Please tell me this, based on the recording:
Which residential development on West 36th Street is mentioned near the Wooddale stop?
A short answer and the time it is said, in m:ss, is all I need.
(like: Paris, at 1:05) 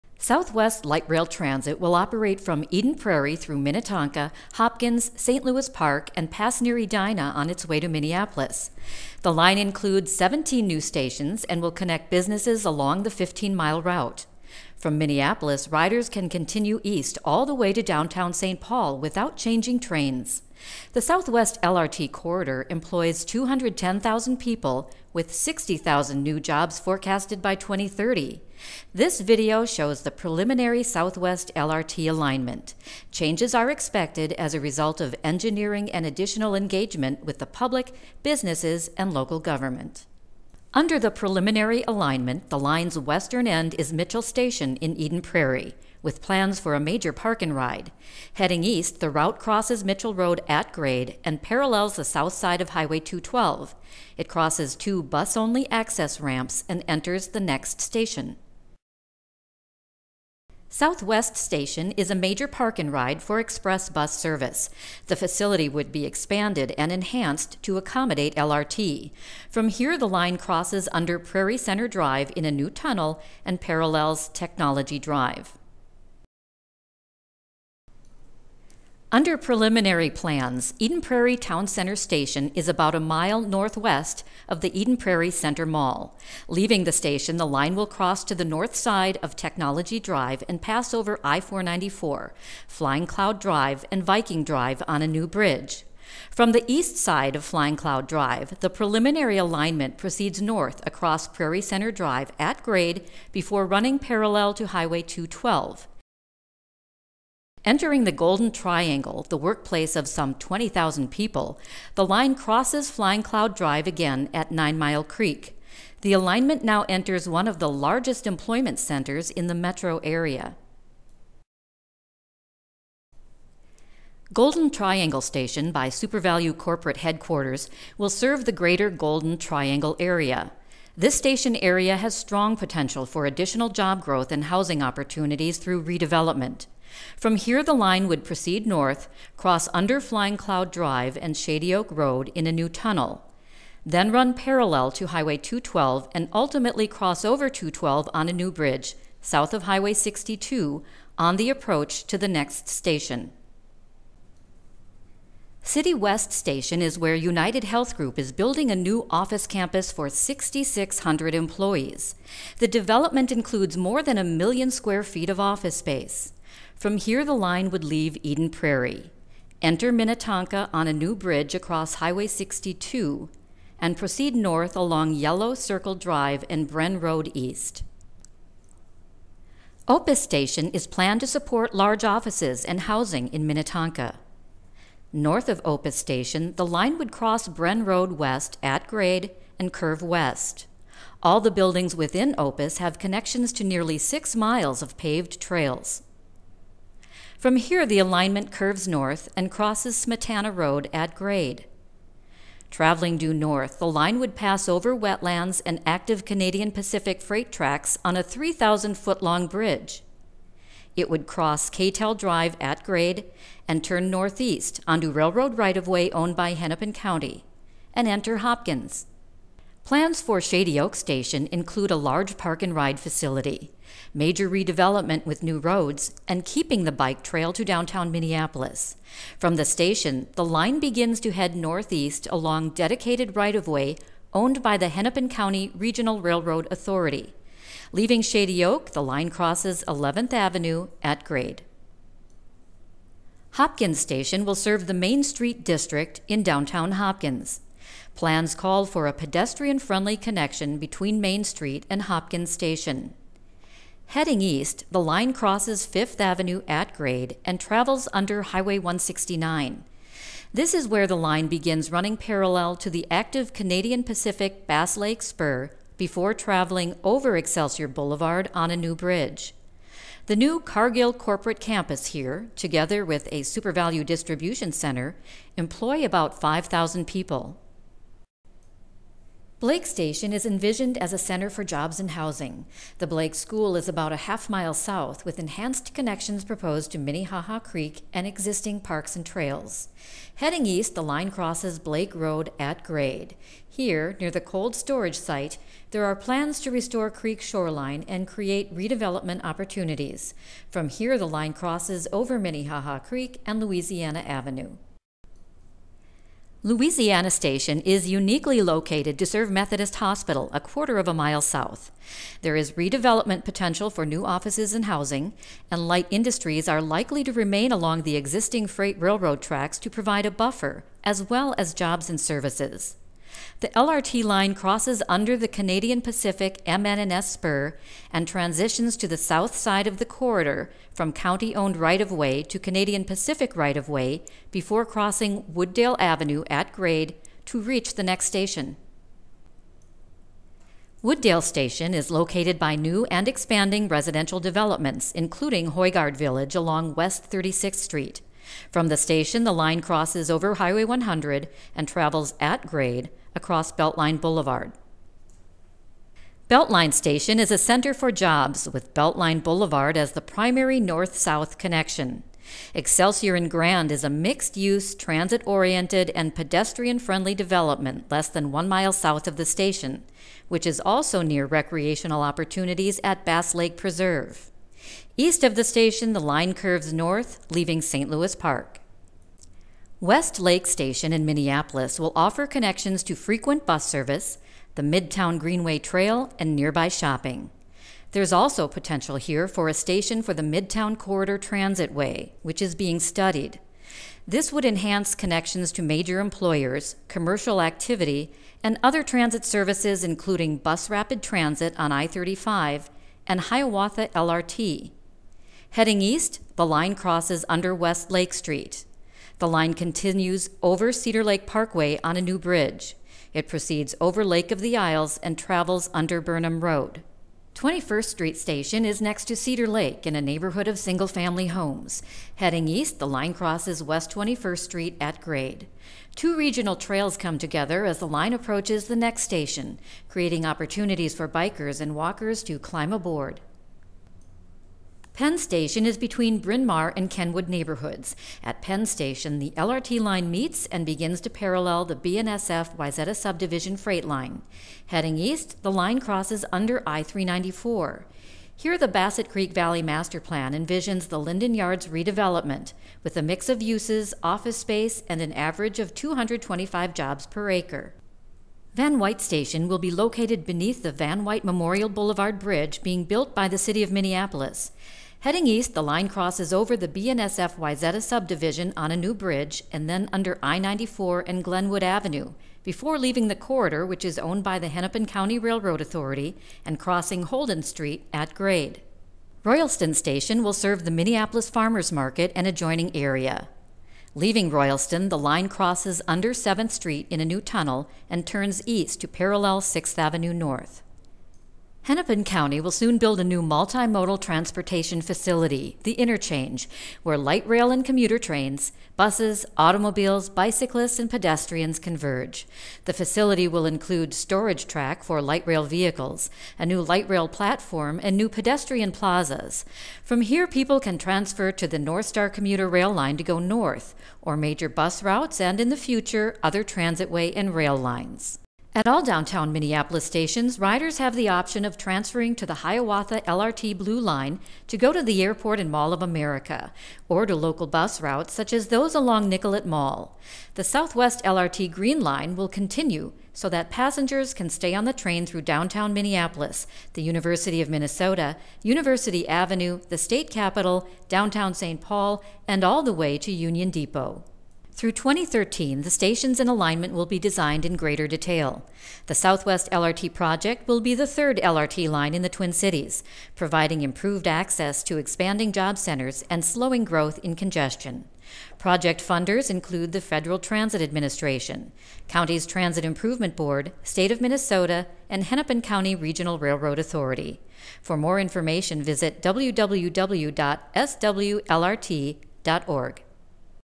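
Hoigaard Village, at 5:45.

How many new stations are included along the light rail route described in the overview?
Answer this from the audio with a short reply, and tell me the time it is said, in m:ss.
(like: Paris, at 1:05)
17, at 0:10.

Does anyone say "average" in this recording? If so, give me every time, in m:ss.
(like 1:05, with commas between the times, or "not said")
7:35.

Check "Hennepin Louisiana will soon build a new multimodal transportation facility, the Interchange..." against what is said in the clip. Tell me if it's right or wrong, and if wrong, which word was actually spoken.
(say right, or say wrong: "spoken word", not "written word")
wrong: "County", not "Louisiana".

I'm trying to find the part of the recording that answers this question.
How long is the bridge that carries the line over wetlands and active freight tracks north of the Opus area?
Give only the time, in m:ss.
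3:28.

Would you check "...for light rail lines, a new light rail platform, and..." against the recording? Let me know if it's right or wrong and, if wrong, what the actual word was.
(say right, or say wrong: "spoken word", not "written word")
wrong: "vehicles", not "lines".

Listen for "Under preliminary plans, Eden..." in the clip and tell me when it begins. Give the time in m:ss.
1:19.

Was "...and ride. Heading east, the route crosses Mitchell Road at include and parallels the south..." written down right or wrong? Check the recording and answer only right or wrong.
wrong.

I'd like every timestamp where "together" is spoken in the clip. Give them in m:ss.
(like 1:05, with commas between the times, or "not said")
4:32, 7:07.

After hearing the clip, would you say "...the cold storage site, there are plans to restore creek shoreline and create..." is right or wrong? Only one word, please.
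right.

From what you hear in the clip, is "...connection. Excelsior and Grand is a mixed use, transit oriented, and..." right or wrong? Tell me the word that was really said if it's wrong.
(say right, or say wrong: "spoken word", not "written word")
right.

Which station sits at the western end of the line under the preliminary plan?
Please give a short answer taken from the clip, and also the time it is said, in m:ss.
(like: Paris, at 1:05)
Mitchell Station, at 0:43.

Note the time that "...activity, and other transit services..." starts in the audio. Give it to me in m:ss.
6:37.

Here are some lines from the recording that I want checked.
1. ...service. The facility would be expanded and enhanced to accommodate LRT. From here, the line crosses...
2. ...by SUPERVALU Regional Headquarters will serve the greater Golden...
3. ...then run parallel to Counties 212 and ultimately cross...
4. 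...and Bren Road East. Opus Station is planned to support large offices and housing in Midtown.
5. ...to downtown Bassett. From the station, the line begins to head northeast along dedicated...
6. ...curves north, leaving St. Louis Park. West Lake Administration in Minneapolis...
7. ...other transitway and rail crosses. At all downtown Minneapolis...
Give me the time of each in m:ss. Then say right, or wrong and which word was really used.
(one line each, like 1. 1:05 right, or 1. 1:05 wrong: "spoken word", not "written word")
1. 1:04 right
2. 2:05 wrong: "Corporate", not "Regional"
3. 2:23 wrong: "Highway", not "Counties"
4. 2:56 wrong: "Minnetonka", not "Midtown"
5. 3:47 wrong: "Minneapolis", not "Bassett"
6. 6:16 wrong: "Station", not "Administration"
7. 8:36 wrong: "lines", not "crosses".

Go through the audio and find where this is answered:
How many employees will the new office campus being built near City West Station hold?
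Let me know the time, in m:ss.
2:40.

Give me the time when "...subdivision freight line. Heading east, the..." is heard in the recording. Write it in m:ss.
7:23.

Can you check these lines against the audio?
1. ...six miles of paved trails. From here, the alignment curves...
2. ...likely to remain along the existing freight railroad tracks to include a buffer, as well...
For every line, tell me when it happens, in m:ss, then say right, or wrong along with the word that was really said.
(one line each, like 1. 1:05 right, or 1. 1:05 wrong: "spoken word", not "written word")
1. 3:13 right
2. 5:16 wrong: "provide", not "include".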